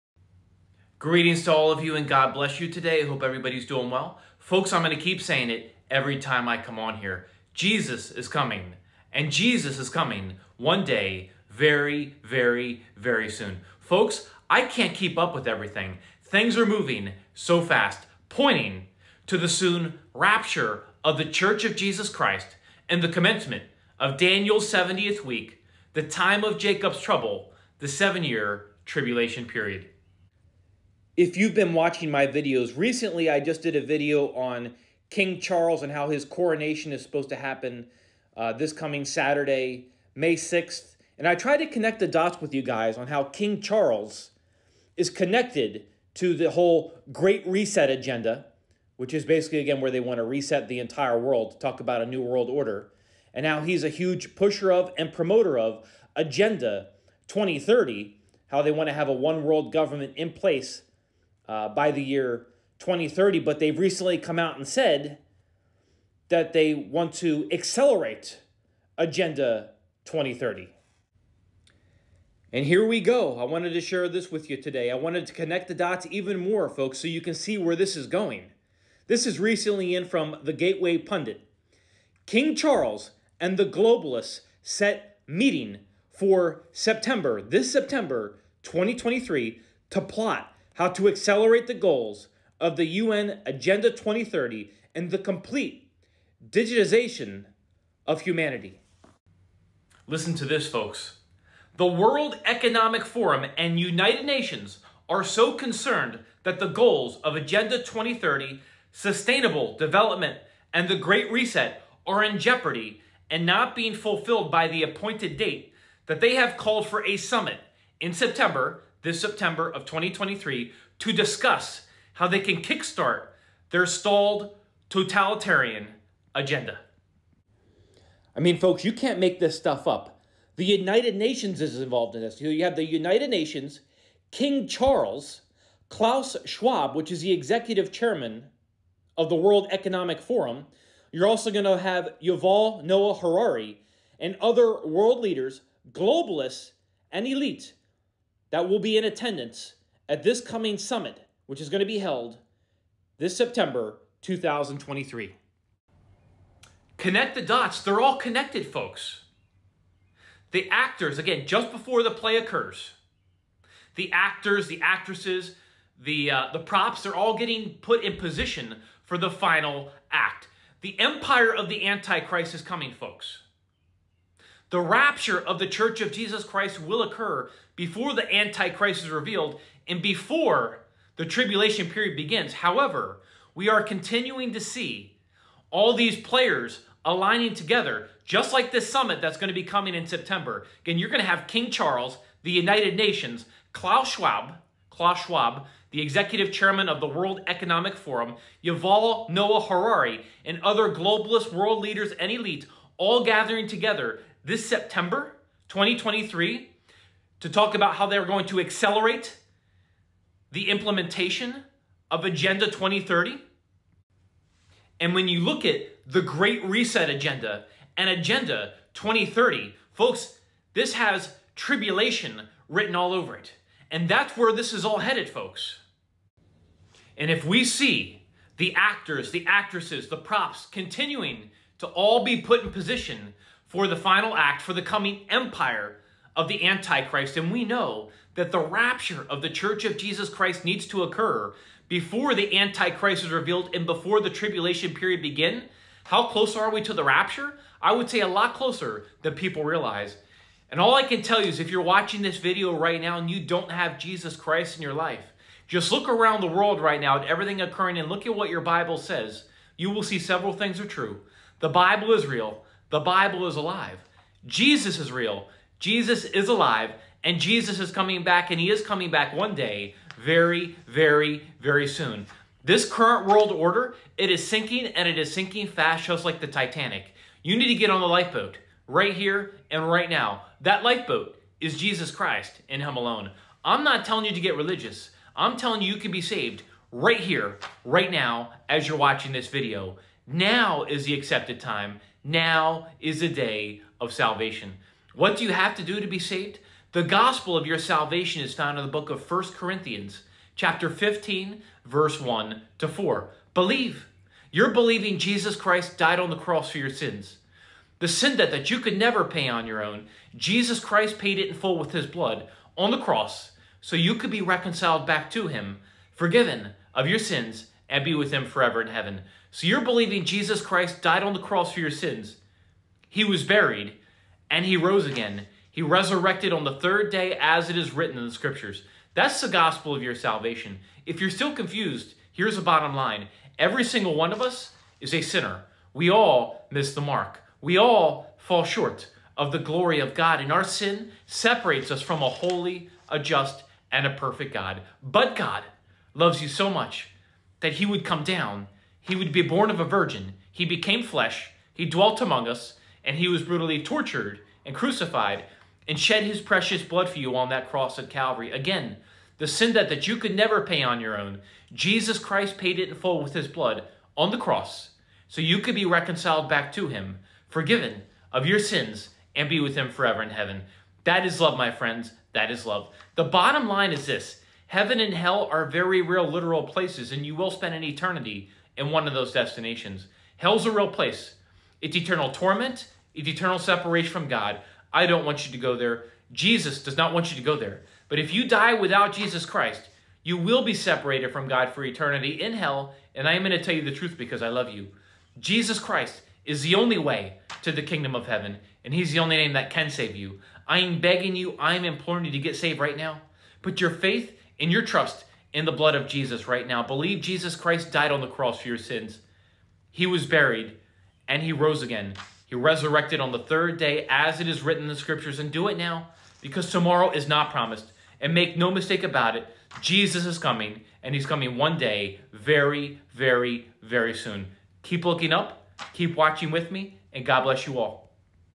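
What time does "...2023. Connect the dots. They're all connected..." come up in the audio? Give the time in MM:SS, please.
02:34.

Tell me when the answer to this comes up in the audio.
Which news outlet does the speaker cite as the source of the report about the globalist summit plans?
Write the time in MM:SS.
01:20.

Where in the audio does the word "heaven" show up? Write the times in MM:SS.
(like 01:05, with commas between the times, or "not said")
05:18, 06:10, 06:14, 06:38.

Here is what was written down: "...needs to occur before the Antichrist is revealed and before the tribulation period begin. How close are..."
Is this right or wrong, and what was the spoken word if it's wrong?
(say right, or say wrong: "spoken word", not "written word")
right.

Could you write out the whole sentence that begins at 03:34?
And when you look at the Great Reset Agenda and Agenda 2030, folks, this has tribulation written all over it.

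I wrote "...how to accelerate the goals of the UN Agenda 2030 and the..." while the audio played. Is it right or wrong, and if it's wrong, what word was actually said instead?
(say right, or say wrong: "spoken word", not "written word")
right.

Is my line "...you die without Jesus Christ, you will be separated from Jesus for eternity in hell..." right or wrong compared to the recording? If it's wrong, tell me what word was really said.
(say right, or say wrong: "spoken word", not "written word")
wrong: "God", not "Jesus".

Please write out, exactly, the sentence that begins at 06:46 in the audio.
Believe Jesus Christ died on the cross for your sins.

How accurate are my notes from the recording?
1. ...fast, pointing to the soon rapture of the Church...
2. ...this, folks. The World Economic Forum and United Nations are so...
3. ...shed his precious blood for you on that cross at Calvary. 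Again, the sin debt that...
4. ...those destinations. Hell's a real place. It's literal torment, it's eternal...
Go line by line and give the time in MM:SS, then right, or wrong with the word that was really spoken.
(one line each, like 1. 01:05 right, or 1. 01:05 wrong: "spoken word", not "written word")
1. 00:17 right
2. 01:40 right
3. 05:55 right
4. 06:19 wrong: "eternal", not "literal".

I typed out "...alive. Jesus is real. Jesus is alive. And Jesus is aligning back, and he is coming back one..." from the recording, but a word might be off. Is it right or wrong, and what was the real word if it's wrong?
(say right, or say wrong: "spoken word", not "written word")
wrong: "coming", not "aligning".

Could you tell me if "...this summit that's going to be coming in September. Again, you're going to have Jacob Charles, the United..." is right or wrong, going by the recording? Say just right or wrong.
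wrong.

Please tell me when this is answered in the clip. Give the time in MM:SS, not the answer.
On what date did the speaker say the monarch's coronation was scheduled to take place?
00:40.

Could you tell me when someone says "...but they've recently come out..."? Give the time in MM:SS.
01:03.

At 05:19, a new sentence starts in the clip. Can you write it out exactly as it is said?
So you're believing Jesus Christ died on the cross for your sins.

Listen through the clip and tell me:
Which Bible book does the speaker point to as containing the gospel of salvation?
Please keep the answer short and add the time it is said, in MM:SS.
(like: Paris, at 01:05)
1 Corinthians, at 04:59.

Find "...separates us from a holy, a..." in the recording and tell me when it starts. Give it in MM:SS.
05:41.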